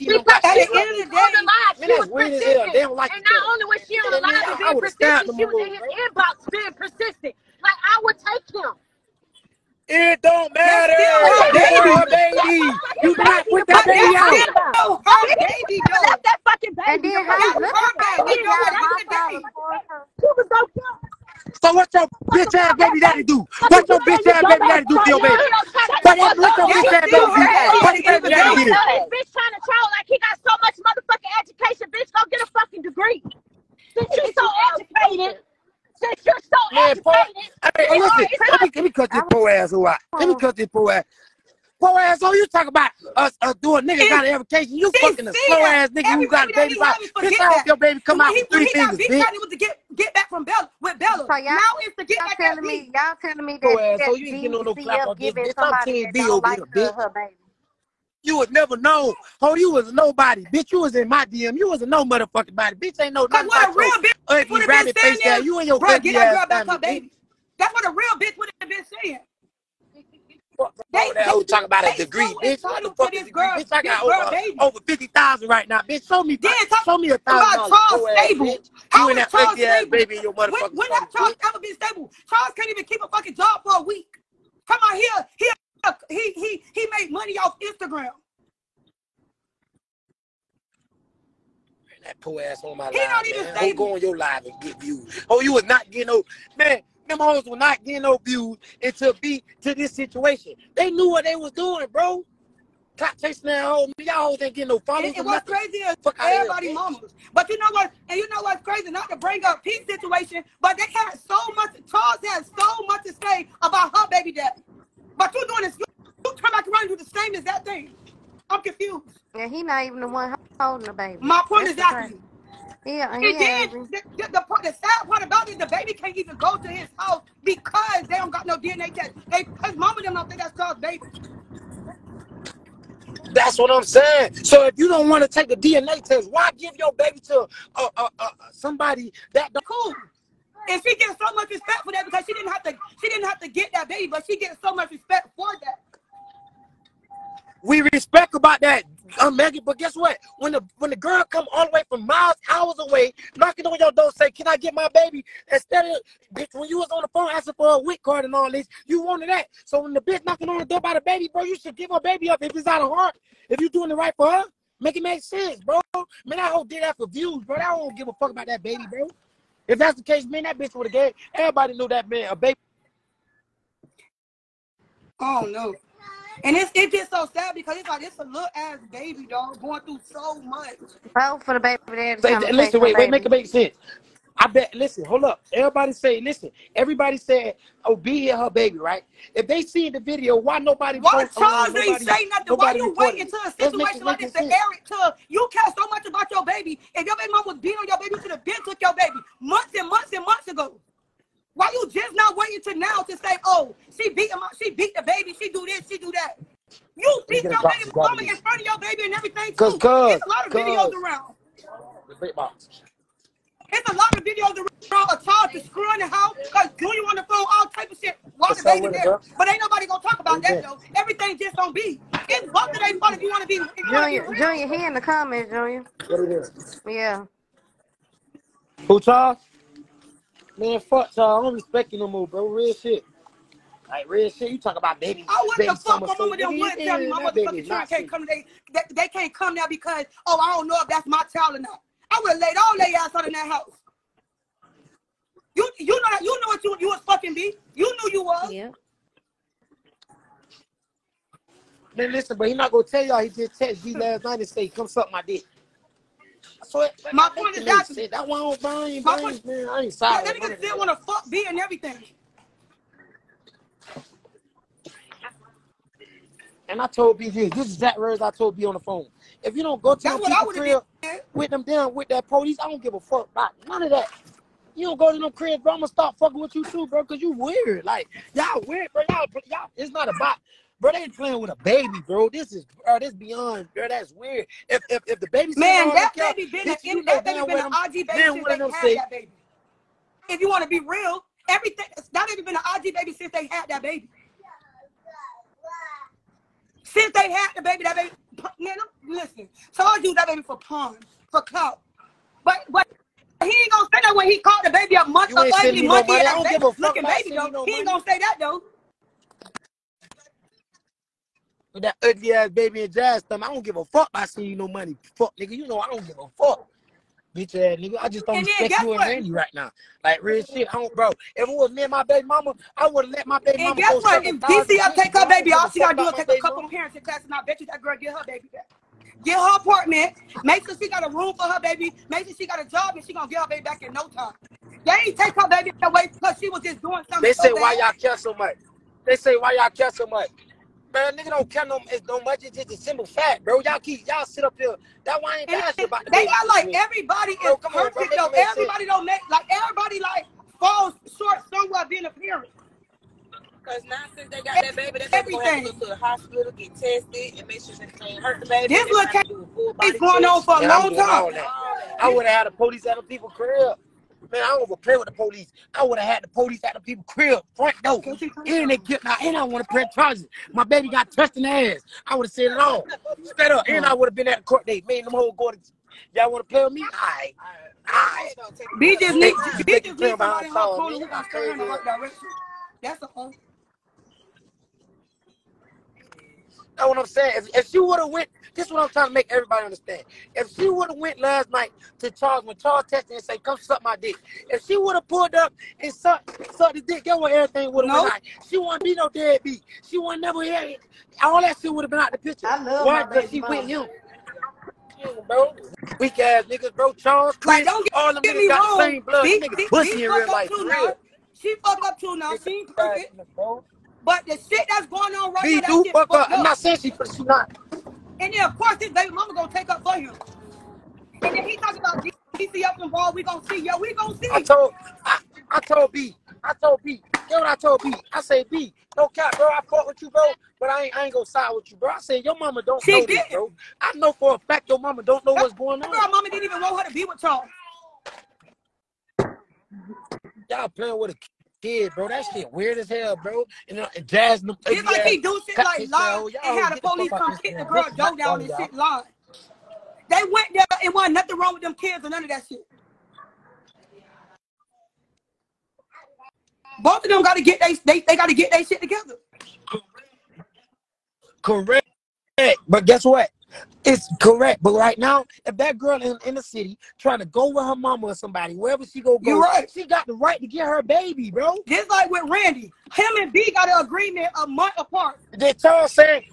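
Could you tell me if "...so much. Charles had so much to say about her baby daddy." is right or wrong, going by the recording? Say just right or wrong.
right.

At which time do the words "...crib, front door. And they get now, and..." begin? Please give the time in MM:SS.
06:07.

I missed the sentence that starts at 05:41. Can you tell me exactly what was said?
Nigga don't care no no much.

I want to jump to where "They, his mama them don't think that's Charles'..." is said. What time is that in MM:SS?
02:09.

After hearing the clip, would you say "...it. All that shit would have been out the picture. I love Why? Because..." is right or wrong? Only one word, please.
right.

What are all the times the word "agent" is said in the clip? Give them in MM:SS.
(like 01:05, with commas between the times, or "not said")
not said.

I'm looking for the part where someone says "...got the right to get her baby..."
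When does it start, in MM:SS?
07:49.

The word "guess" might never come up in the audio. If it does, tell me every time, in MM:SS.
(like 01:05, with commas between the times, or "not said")
02:29, 05:23, 07:42.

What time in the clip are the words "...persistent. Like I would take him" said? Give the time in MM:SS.
00:06.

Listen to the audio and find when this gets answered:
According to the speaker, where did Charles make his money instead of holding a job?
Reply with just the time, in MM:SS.
01:27.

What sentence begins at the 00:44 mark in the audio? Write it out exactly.
You fucking a slow ass nigga who got a baby out.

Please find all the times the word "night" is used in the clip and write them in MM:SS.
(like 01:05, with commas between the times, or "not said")
04:14, 06:31.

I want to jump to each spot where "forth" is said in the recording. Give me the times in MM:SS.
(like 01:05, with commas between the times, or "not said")
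not said.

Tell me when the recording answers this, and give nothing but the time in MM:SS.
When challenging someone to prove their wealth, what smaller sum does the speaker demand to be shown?
01:17.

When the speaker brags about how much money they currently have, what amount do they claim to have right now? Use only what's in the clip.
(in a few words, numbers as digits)
over 50,000.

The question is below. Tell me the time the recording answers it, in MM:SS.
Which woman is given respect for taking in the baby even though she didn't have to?
02:29.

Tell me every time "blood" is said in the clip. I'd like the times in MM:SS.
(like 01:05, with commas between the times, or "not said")
06:49.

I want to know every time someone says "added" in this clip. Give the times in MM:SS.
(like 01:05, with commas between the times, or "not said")
not said.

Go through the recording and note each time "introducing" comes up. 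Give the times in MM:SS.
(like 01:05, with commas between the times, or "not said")
not said.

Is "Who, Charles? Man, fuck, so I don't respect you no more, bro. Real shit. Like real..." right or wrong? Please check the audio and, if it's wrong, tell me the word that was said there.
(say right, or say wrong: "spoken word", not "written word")
right.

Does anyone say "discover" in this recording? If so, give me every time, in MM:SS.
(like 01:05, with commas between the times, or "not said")
not said.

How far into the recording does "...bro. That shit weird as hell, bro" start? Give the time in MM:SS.
07:21.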